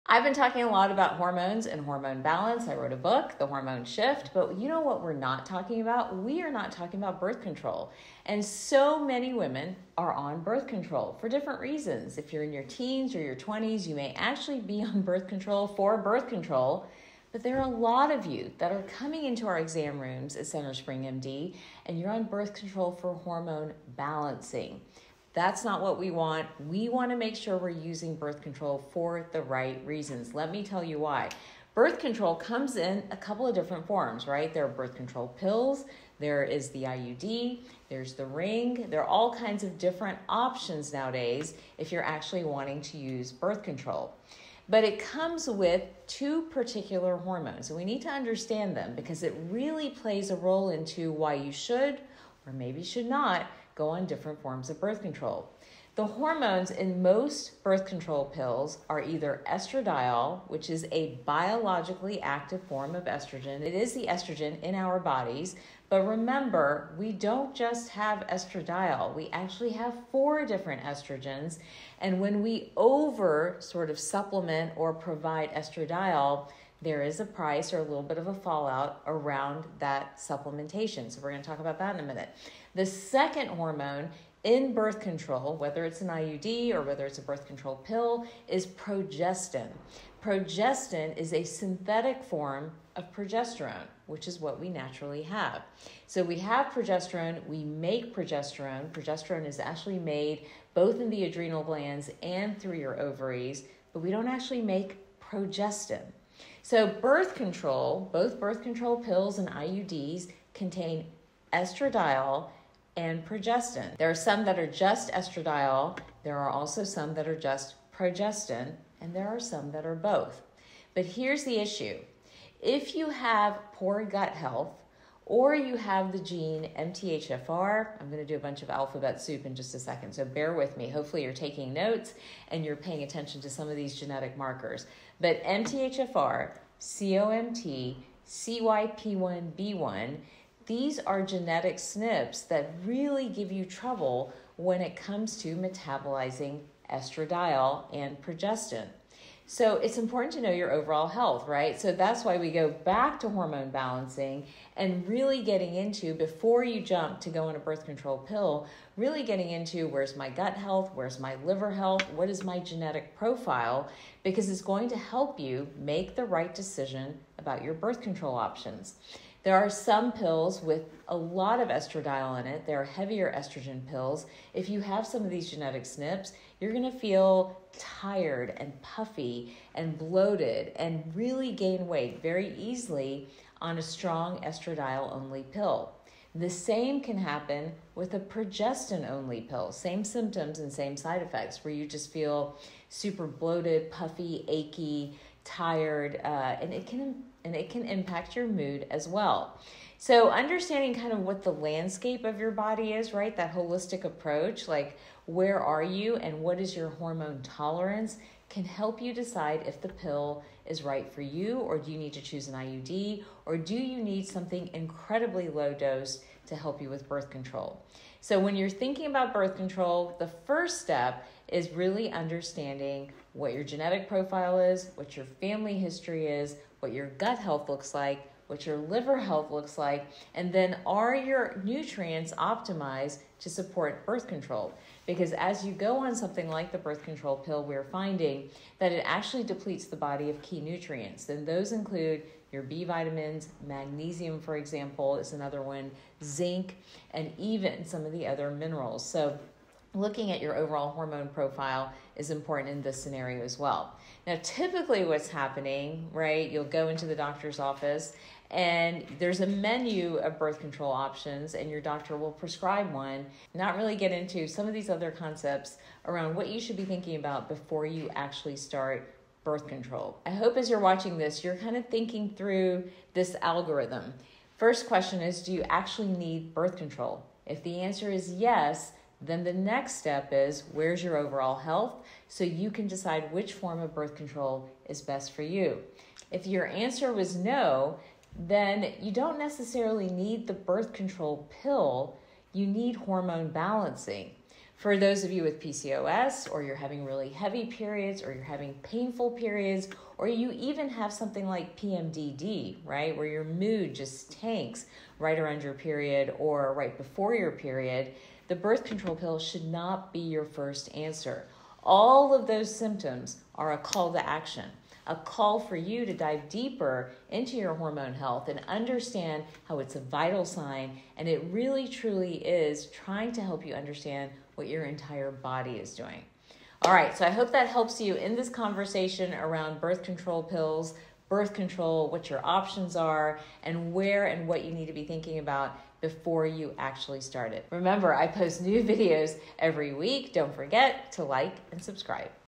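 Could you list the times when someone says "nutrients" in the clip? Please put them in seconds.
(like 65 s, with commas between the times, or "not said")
231 s, 240 s.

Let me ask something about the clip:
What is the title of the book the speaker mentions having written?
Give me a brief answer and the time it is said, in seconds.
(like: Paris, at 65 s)
The Hormone Shift, at 3 s.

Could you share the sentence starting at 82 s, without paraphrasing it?
The second hormone in birth control, whether it's an IUD or whether it's a birth control pill, is progestin.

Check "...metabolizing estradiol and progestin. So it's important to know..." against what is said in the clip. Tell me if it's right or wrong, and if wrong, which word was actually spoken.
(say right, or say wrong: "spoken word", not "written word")
right.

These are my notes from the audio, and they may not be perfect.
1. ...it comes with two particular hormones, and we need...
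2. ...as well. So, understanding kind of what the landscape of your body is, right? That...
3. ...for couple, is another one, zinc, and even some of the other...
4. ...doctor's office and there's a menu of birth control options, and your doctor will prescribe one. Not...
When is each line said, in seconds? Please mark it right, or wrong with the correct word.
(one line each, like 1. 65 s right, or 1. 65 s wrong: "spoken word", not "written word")
1. 44 s right
2. 198 s right
3. 244 s wrong: "example", not "couple"
4. 257 s right.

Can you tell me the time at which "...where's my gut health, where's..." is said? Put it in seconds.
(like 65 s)
159 s.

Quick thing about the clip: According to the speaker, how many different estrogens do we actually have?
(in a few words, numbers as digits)
4.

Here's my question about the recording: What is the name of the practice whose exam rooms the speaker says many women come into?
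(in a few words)
CentreSpring MD.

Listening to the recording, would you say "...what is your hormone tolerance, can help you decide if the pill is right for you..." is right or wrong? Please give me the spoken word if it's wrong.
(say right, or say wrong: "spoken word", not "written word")
right.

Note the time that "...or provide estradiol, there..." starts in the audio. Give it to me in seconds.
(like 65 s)
74 s.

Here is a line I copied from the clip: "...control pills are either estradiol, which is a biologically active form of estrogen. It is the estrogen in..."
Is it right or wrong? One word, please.
right.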